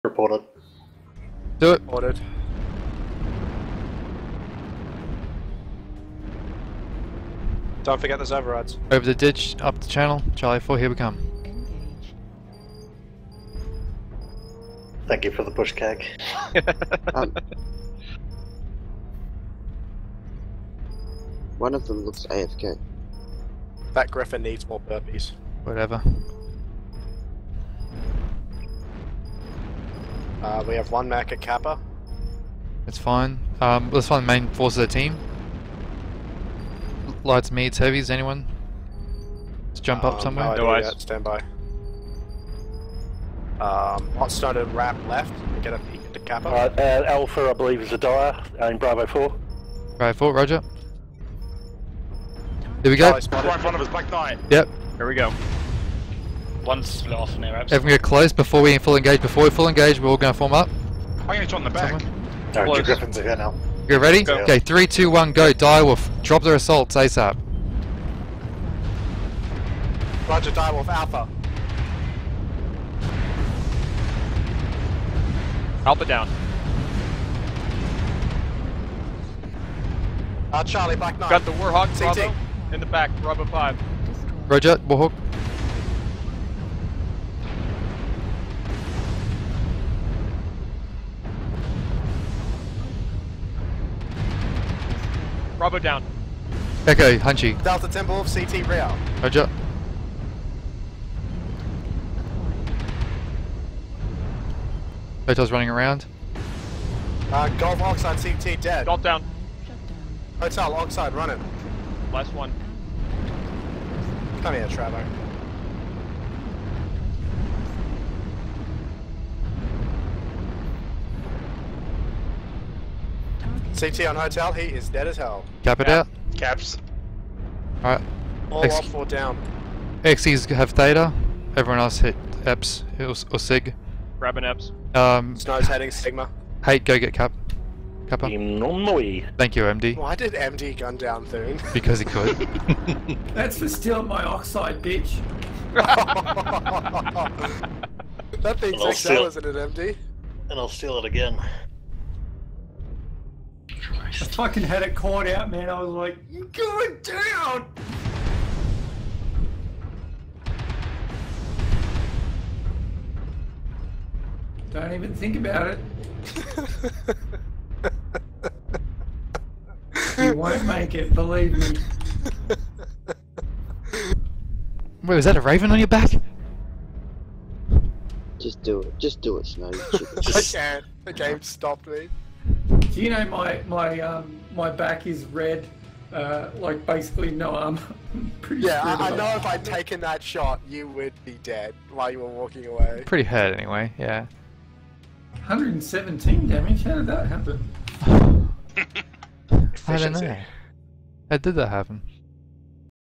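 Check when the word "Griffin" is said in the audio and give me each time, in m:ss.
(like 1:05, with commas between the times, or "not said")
0:24, 1:02.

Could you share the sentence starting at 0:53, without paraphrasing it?
Right in front of us, Black Knight.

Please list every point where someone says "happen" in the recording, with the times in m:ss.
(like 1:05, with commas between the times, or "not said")
3:17, 3:21.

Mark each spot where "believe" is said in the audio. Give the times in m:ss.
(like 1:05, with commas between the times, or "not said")
0:47, 2:51.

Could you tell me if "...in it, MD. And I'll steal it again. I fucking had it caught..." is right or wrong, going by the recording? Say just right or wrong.
right.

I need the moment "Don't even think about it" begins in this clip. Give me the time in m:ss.
2:44.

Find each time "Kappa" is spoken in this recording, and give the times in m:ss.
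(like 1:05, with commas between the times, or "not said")
0:31, 0:46, 2:18.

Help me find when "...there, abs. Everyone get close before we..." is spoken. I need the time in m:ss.
0:57.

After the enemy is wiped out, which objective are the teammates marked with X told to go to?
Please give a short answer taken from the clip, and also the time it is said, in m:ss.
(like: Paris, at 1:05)
Theta, at 2:10.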